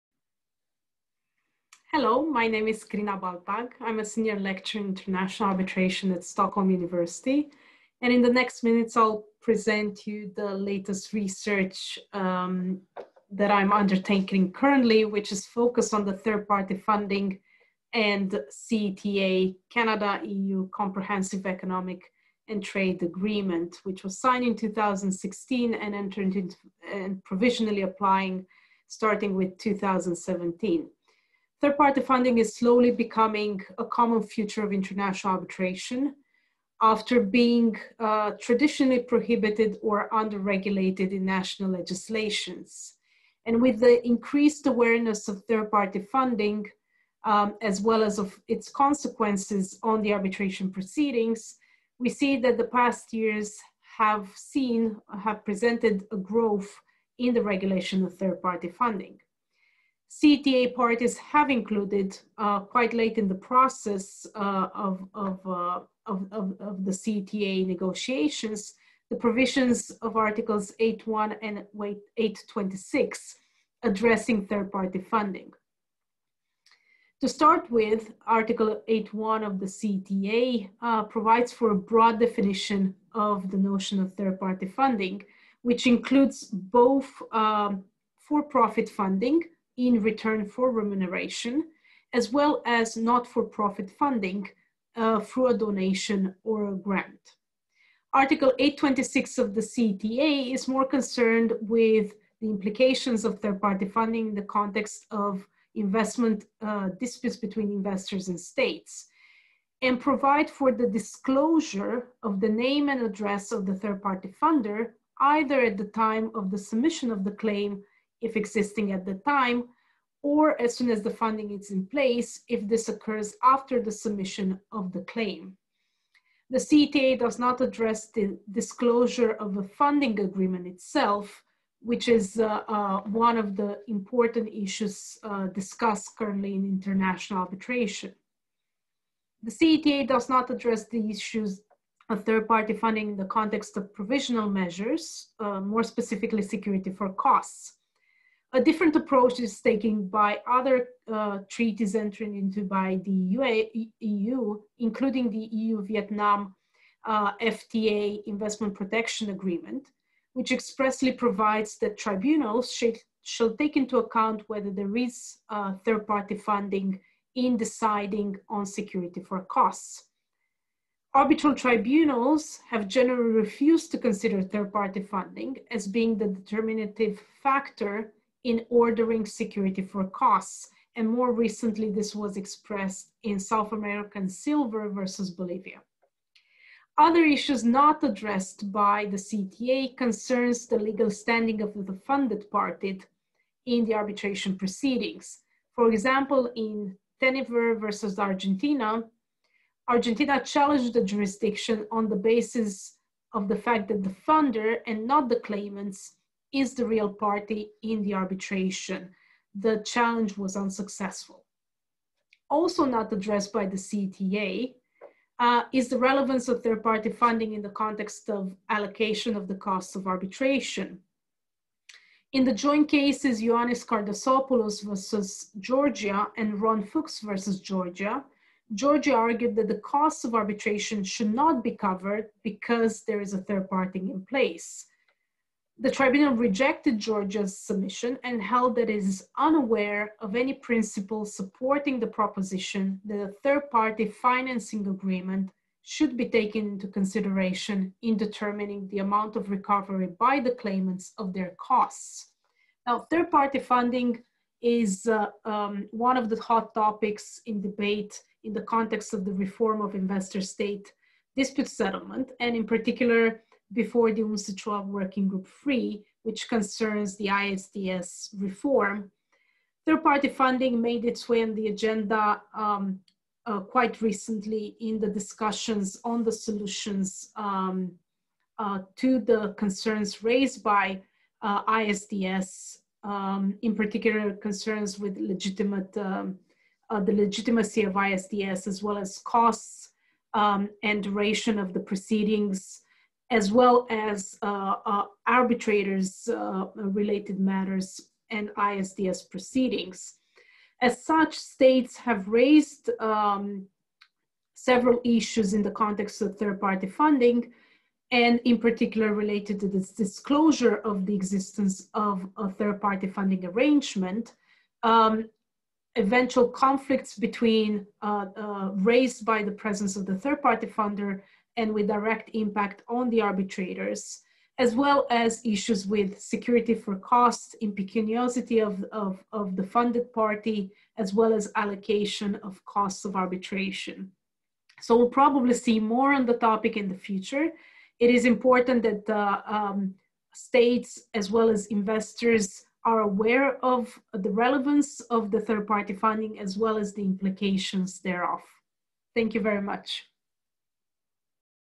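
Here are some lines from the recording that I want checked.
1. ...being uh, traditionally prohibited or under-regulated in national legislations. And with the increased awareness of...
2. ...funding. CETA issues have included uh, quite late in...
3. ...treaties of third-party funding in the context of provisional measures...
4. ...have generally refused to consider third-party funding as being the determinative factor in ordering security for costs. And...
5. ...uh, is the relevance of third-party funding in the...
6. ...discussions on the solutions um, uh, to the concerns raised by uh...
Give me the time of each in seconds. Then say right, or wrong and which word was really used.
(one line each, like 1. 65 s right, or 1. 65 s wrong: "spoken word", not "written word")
1. 37 s right
2. 58 s wrong: "parties", not "issues"
3. 141 s wrong: "issues", not "treaties"
4. 172 s right
5. 215 s right
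6. 275 s right.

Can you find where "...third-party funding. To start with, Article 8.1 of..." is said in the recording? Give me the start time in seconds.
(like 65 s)
74 s.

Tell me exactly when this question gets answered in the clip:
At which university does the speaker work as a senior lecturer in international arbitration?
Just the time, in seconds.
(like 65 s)
6 s.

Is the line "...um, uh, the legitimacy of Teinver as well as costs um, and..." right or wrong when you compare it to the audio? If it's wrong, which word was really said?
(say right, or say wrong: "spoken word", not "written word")
wrong: "ISDS", not "Teinver".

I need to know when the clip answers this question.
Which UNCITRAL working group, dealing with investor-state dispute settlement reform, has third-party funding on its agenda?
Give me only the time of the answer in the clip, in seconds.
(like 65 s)
264 s.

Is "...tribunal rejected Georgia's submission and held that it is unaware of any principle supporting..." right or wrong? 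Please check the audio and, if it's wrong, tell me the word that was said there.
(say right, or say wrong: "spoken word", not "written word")
right.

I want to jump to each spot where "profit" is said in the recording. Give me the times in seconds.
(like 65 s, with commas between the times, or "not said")
88 s, 92 s.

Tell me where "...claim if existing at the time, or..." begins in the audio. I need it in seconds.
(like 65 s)
117 s.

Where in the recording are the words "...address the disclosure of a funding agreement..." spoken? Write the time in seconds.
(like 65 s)
127 s.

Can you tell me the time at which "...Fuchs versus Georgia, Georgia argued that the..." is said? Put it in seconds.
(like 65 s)
226 s.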